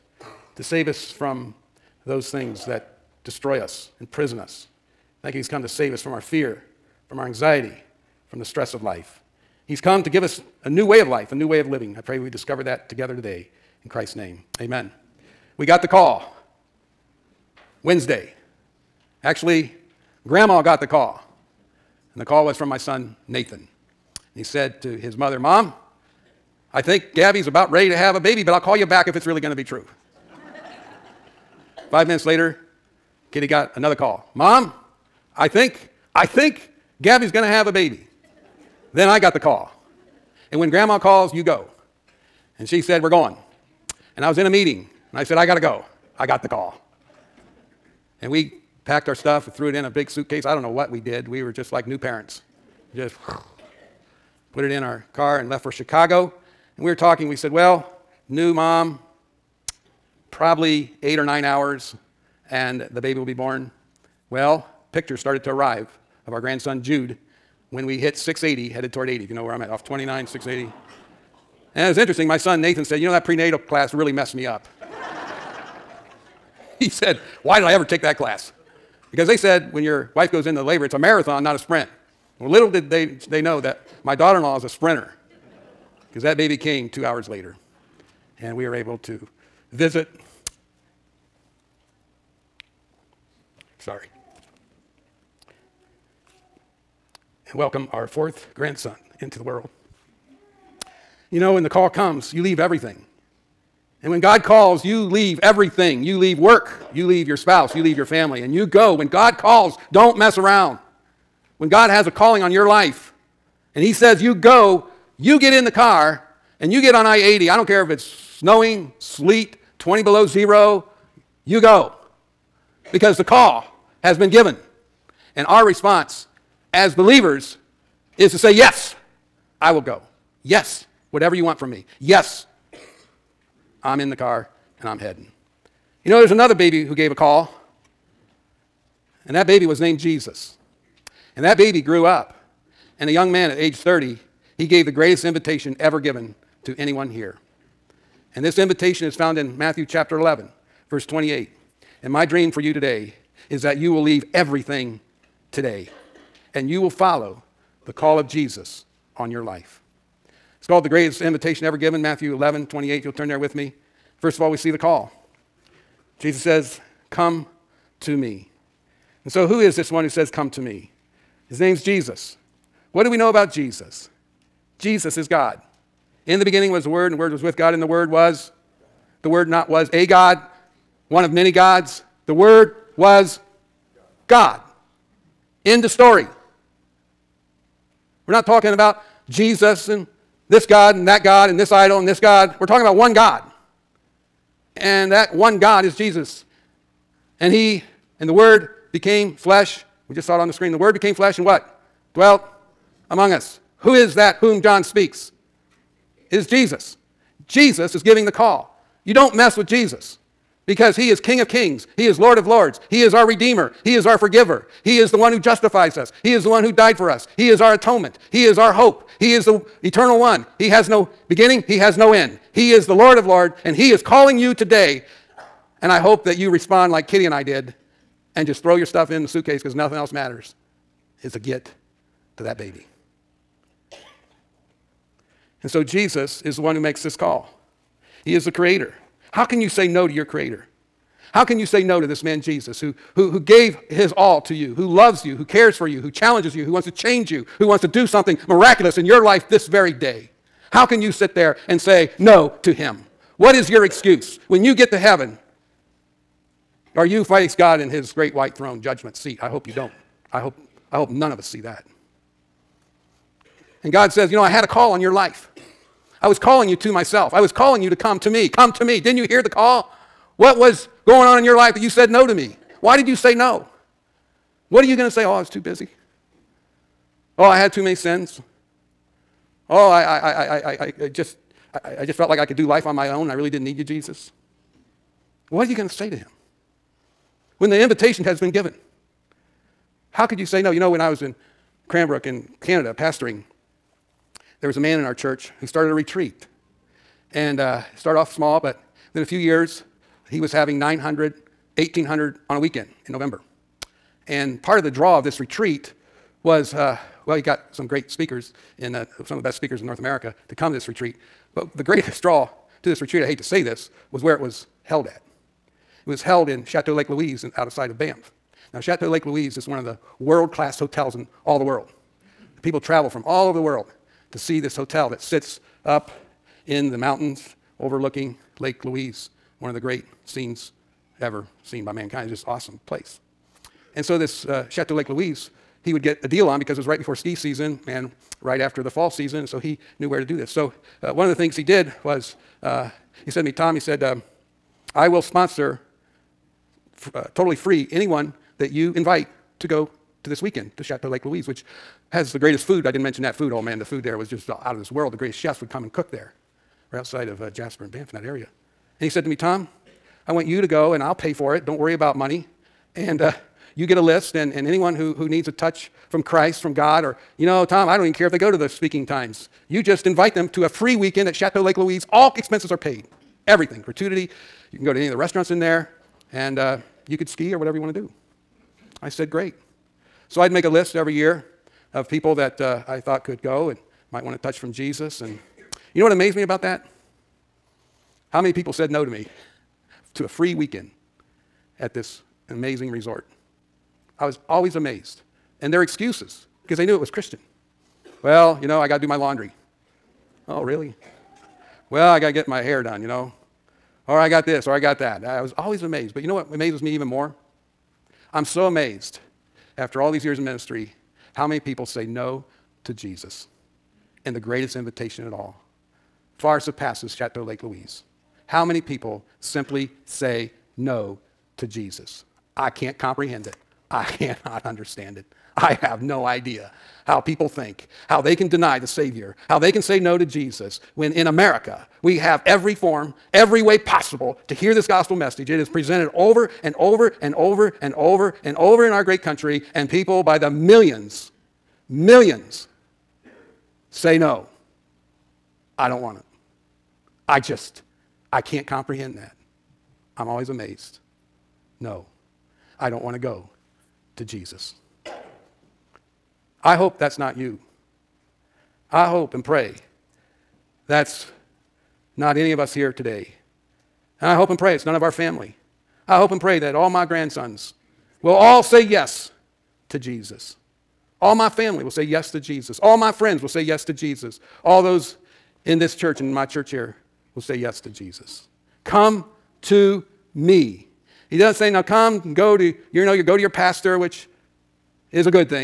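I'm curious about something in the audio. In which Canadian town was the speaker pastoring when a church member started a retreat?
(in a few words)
Cranbrook.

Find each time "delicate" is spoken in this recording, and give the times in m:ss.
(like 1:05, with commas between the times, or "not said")
not said.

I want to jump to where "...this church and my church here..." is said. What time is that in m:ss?
7:55.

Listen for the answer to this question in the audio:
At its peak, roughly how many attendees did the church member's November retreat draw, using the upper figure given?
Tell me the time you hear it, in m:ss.
5:01.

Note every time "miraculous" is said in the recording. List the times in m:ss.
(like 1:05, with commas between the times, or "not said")
4:08.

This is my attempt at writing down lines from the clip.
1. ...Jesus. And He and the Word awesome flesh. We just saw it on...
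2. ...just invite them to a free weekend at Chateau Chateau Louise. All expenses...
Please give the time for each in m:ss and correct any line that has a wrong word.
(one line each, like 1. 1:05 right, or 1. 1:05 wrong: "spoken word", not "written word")
1. 3:15 wrong: "became", not "awesome"
2. 6:09 wrong: "Lake", not "Chateau".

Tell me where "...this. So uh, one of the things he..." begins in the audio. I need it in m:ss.
5:40.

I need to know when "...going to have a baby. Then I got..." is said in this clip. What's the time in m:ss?
0:37.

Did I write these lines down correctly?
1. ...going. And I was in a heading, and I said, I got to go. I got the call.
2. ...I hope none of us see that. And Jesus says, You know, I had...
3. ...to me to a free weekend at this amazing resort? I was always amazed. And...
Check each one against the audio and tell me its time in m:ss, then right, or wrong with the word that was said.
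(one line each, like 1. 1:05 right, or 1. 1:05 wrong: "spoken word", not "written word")
1. 0:43 wrong: "meeting", not "heading"
2. 4:20 wrong: "God", not "Jesus"
3. 6:29 right.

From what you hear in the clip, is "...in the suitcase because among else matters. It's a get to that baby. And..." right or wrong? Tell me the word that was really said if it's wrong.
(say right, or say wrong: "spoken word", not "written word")
wrong: "nothing", not "among".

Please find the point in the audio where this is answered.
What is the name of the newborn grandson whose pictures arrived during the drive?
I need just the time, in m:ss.
1:06.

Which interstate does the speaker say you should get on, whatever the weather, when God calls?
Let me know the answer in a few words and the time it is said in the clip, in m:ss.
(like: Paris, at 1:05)
I 80, at 1:57.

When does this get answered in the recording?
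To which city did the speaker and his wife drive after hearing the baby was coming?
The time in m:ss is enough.
0:55.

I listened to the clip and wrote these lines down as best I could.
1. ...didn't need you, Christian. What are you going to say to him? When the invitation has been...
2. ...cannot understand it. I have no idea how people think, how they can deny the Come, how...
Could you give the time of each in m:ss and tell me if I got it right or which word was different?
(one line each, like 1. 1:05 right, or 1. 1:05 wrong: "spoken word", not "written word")
1. 4:43 wrong: "Jesus", not "Christian"
2. 7:04 wrong: "Savior", not "Come".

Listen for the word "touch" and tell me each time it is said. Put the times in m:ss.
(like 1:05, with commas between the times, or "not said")
6:05, 6:24.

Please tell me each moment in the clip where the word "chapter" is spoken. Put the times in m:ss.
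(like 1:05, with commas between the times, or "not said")
2:29.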